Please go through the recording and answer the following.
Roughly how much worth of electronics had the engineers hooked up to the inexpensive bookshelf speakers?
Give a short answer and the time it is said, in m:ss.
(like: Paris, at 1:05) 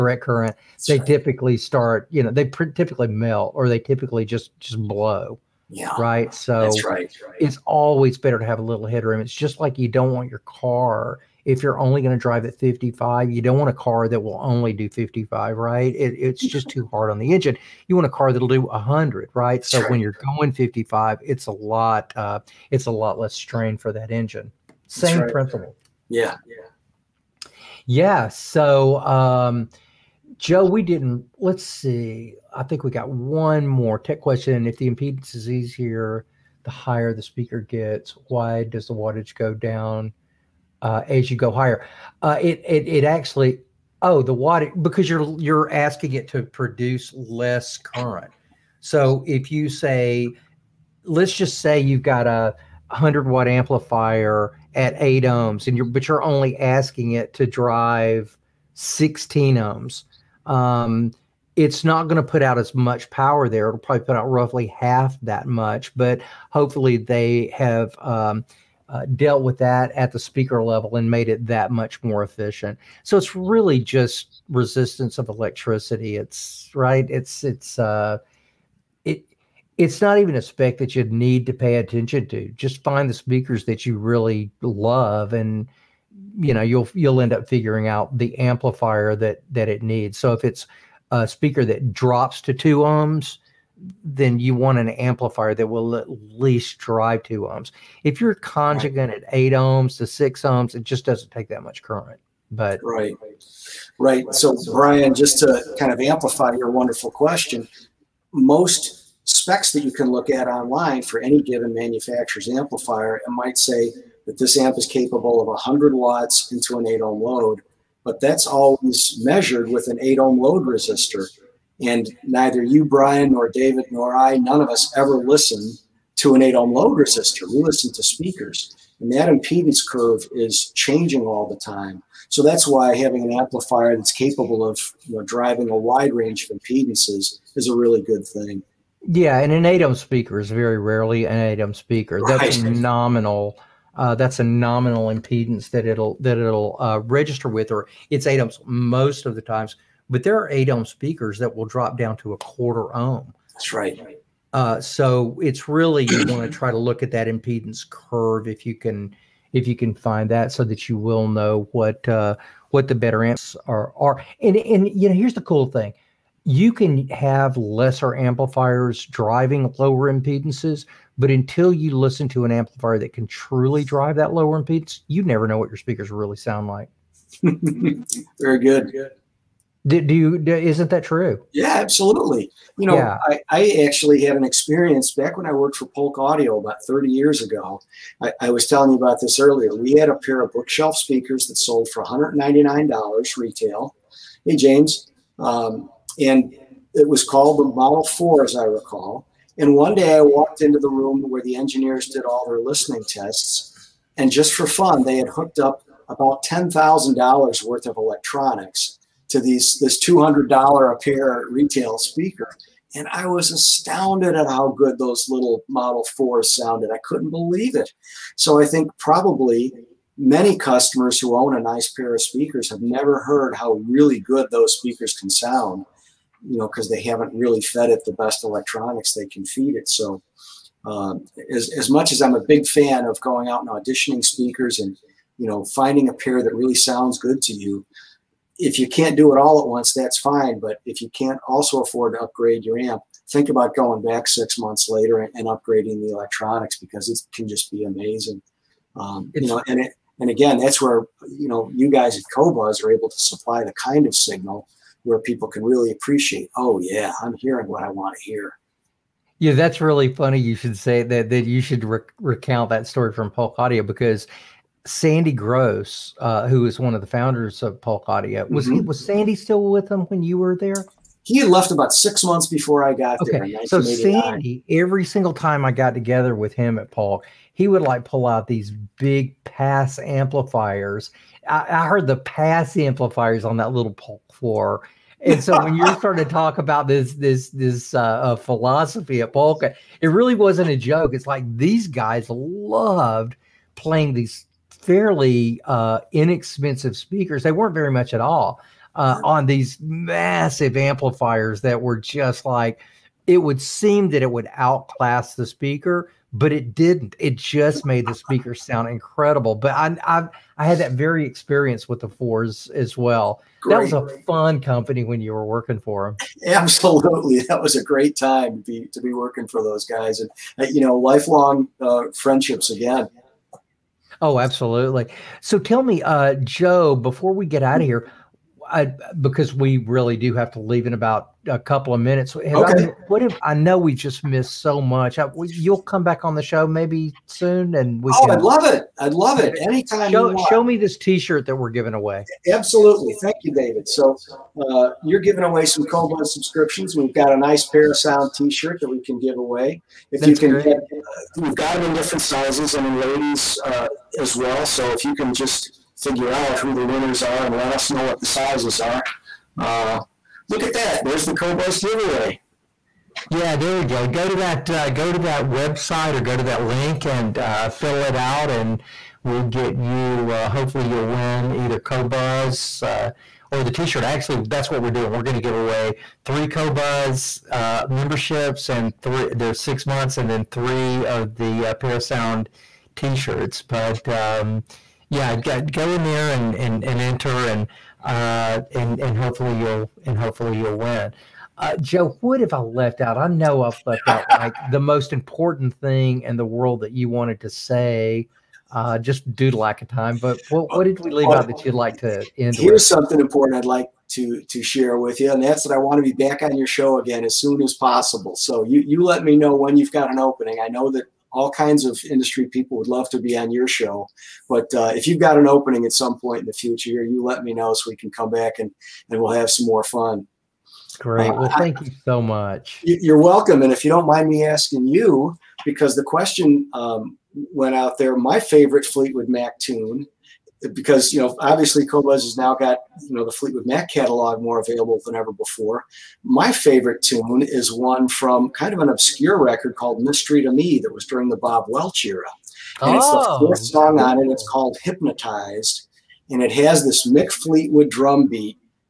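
$10,000, at 3:26.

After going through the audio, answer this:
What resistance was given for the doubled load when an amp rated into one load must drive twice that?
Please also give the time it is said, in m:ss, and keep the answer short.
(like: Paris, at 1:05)
16 ohms, at 0:58.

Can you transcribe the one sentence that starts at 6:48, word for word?
So you you let me know when you've got an opening.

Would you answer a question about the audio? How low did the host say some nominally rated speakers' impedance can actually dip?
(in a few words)
a quarter ohm.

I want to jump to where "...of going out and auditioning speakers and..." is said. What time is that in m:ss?
3:53.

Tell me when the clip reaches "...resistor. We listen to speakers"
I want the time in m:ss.
2:06.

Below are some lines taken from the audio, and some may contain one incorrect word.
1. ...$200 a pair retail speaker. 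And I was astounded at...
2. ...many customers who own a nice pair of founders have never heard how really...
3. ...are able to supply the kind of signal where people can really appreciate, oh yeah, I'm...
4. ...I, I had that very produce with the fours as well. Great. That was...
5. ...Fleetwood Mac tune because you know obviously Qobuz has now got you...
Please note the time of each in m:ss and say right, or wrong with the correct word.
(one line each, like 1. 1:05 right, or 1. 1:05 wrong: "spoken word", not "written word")
1. 3:30 right
2. 3:40 wrong: "speakers", not "founders"
3. 4:12 right
4. 5:10 wrong: "experience", not "produce"
5. 7:08 right.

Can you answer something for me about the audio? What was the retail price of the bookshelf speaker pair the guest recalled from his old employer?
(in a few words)
$199.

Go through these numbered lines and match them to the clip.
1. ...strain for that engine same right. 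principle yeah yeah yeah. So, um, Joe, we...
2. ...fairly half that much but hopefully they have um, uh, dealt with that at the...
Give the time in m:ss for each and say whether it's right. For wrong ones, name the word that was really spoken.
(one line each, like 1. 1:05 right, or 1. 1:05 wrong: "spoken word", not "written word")
1. 0:23 right
2. 1:04 wrong: "roughly", not "fairly".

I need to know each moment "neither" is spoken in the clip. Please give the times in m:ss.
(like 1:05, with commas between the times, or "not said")
2:02.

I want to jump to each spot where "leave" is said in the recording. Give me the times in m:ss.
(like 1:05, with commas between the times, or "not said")
5:30, 6:41.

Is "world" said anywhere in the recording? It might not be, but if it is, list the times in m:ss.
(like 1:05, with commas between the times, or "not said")
6:36.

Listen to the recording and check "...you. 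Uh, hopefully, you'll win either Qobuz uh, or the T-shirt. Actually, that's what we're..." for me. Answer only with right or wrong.
right.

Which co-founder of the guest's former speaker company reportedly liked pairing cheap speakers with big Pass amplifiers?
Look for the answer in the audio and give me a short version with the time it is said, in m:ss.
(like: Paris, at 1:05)
Sandy Gross, at 4:24.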